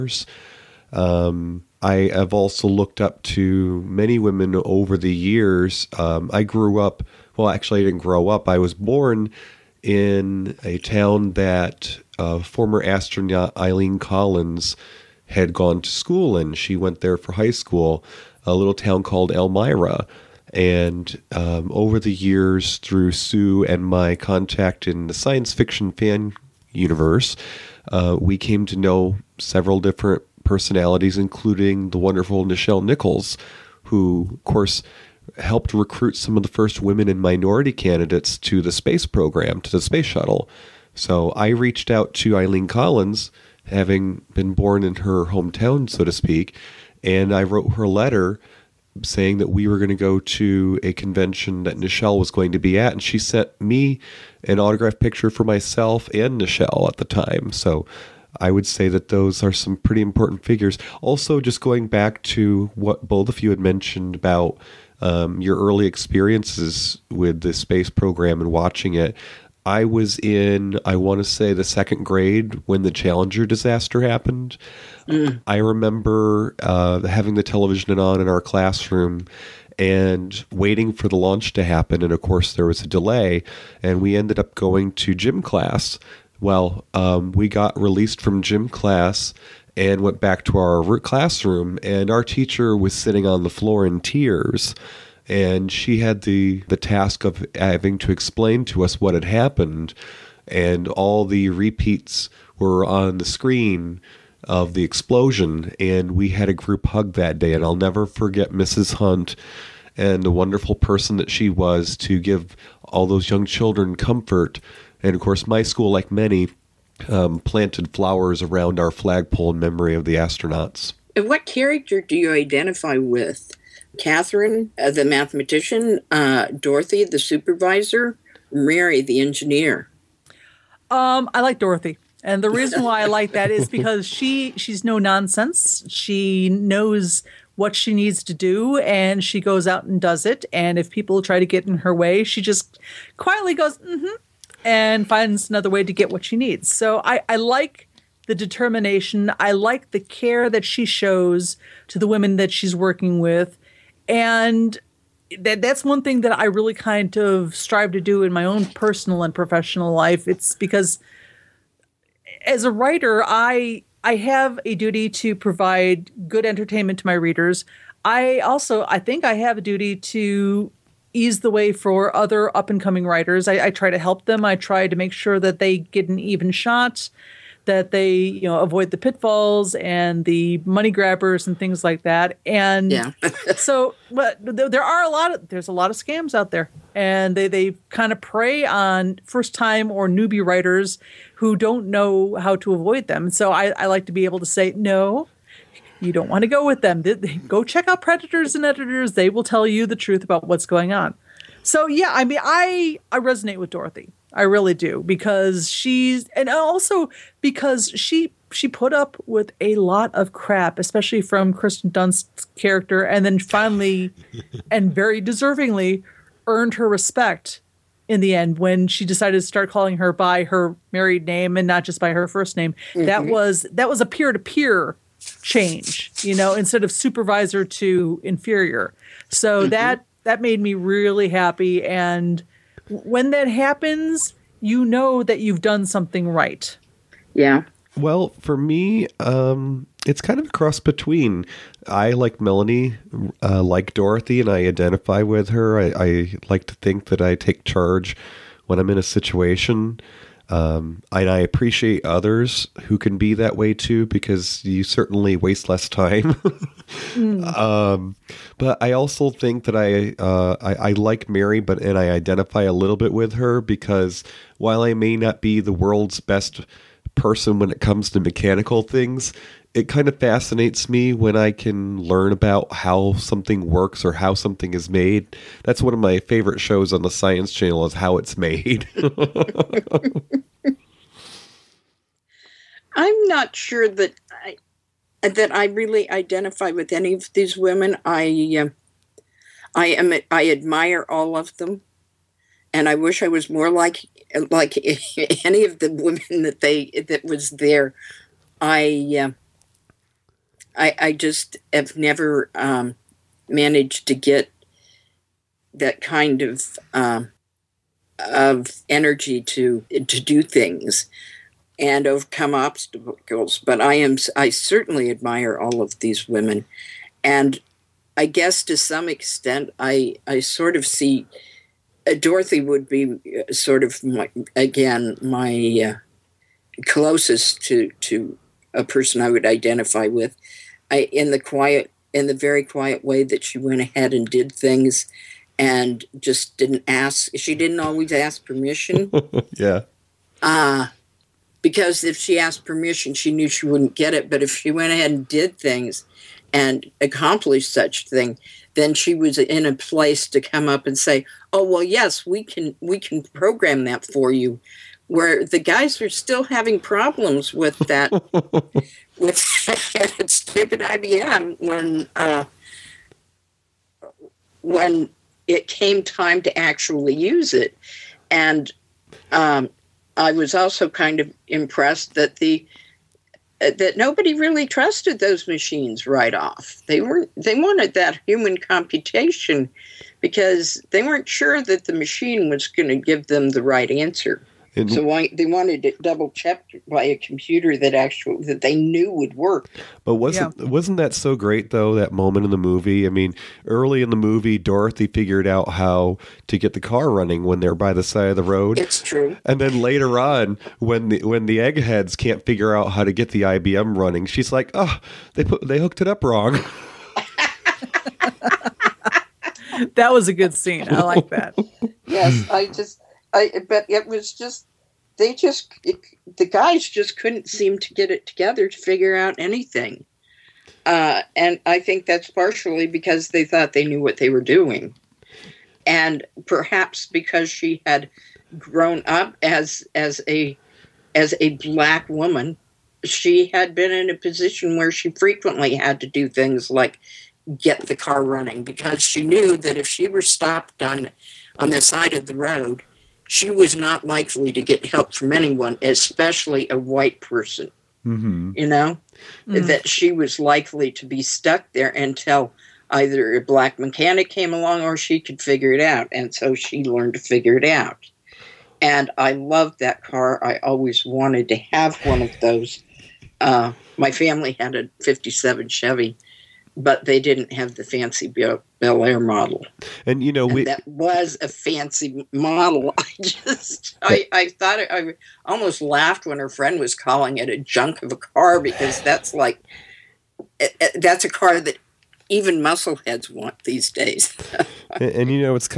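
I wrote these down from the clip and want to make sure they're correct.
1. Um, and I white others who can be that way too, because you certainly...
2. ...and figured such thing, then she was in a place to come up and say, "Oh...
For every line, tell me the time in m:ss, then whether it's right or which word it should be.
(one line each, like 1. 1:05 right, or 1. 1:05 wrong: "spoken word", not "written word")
1. 4:10 wrong: "appreciate", not "white"
2. 5:46 wrong: "accomplished", not "figured".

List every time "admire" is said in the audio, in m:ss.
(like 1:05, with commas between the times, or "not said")
4:50, 5:15.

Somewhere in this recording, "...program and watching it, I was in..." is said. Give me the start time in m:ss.
1:07.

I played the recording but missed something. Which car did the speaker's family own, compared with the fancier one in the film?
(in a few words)
57 Chevy.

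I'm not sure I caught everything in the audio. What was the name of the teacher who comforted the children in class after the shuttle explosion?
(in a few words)
Mrs. Hunt.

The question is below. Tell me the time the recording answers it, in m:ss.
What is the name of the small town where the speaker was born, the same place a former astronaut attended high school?
0:19.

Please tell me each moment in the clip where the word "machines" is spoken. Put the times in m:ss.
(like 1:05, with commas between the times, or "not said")
6:15, 6:21.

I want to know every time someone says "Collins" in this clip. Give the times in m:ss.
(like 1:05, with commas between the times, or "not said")
0:13, 0:42.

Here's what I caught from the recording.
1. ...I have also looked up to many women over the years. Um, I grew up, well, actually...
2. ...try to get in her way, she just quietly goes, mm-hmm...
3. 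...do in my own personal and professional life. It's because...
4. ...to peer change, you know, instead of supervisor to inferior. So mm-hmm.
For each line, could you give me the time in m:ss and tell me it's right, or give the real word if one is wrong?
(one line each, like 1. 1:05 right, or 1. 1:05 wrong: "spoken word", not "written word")
1. 0:01 right
2. 2:21 right
3. 2:37 right
4. 3:44 right.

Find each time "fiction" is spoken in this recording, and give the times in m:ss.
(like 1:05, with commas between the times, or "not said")
0:25.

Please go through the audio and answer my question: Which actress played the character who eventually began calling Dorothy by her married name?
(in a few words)
Kirsten Dunst.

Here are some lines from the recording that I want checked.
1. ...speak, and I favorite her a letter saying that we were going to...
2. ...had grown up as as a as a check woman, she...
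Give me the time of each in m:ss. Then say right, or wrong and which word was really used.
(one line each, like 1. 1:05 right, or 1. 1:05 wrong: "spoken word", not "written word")
1. 0:46 wrong: "wrote", not "favorite"
2. 7:07 wrong: "black", not "check".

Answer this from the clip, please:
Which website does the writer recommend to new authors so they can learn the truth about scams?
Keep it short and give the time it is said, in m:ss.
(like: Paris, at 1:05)
Predators and Editors, at 3:17.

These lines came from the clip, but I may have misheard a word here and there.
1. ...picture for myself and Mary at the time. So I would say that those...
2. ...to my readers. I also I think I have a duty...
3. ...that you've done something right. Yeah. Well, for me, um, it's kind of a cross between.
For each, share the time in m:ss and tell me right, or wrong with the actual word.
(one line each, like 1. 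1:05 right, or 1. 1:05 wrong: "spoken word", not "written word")
1. 0:54 wrong: "Nichelle", not "Mary"
2. 2:46 right
3. 3:55 right.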